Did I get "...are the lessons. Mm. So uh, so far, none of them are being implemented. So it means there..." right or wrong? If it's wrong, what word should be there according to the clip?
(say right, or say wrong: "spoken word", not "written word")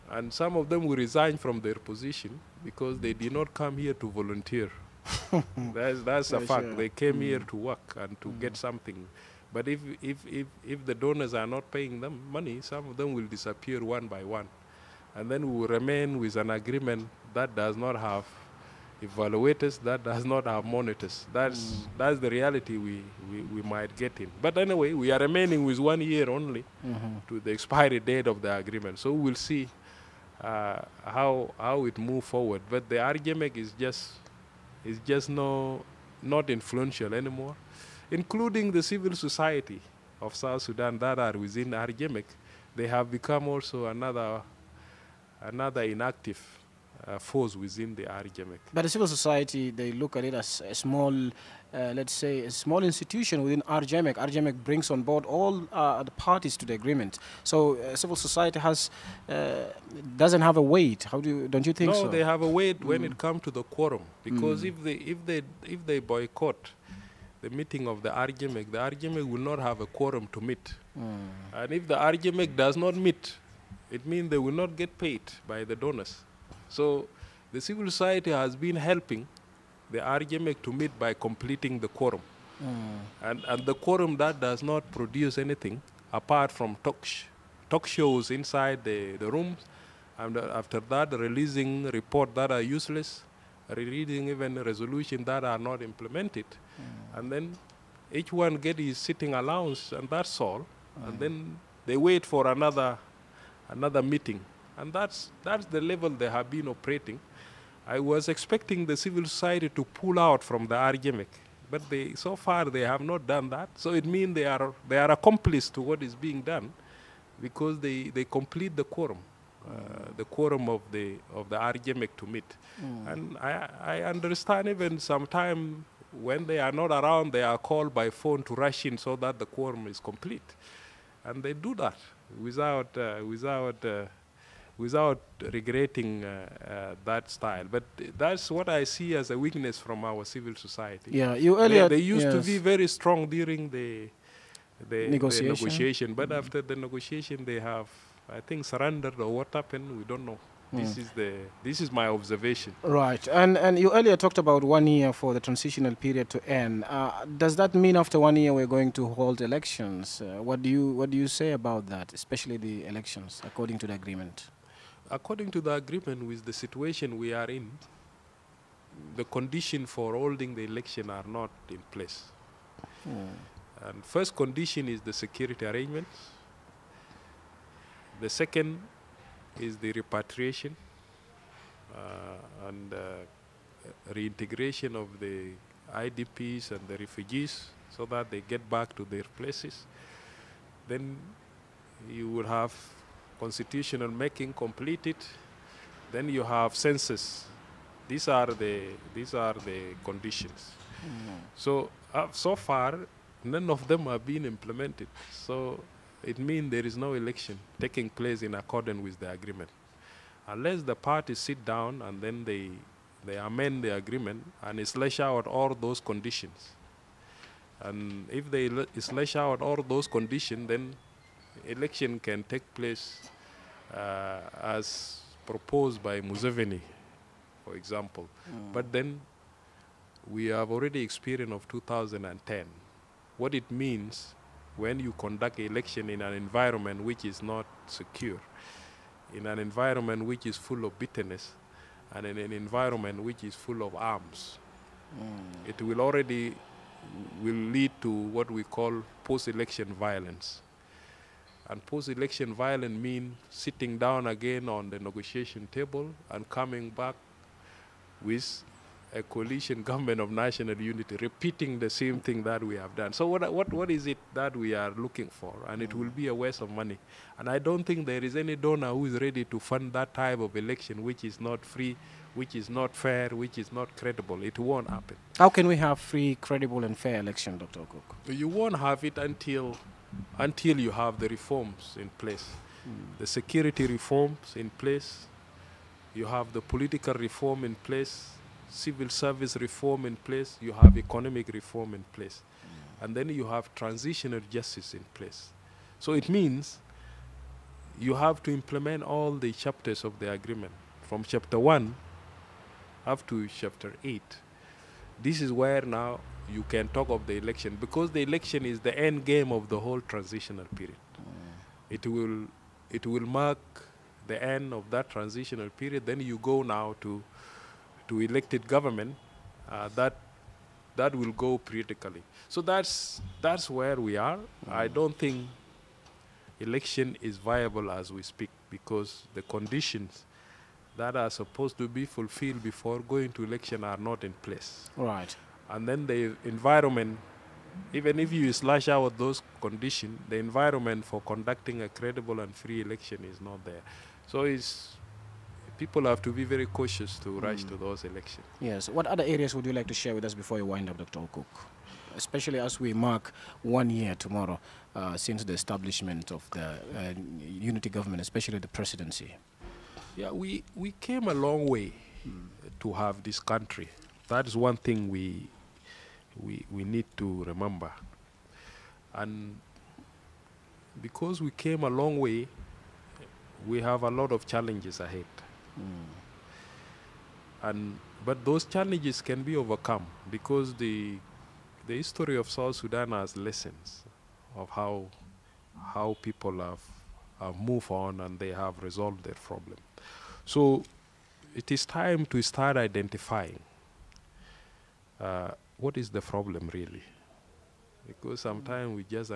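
wrong: "conditions", not "lessons".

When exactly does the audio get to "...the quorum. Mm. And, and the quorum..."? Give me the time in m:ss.
1:21.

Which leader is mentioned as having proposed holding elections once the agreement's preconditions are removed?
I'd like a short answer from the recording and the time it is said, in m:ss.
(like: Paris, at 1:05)
Museveni, at 3:46.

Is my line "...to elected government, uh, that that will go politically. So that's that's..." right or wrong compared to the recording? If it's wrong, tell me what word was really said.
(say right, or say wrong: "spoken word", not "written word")
right.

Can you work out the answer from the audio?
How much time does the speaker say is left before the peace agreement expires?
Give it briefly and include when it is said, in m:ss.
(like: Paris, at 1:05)
1 year, at 0:25.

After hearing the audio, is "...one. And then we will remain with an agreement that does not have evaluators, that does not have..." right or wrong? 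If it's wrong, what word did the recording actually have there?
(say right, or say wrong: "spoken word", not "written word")
right.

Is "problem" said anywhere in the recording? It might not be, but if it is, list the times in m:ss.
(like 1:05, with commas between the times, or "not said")
6:29, 6:36.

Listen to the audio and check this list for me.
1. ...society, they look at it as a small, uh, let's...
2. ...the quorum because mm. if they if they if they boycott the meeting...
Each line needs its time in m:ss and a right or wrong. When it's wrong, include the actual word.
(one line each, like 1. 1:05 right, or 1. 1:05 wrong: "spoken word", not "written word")
1. 0:49 right
2. 1:03 right.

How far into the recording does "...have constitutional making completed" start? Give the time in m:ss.
3:12.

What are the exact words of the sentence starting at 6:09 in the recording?
And because we came a long way, we have a lot of challenges ahead.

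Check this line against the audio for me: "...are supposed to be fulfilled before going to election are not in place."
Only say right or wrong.
right.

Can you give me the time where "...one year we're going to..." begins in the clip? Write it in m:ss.
2:38.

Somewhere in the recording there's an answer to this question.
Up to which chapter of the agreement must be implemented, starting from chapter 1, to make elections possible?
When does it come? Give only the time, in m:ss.
5:03.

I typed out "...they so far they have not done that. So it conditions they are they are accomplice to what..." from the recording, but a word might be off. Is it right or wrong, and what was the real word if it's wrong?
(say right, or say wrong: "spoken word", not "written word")
wrong: "means", not "conditions".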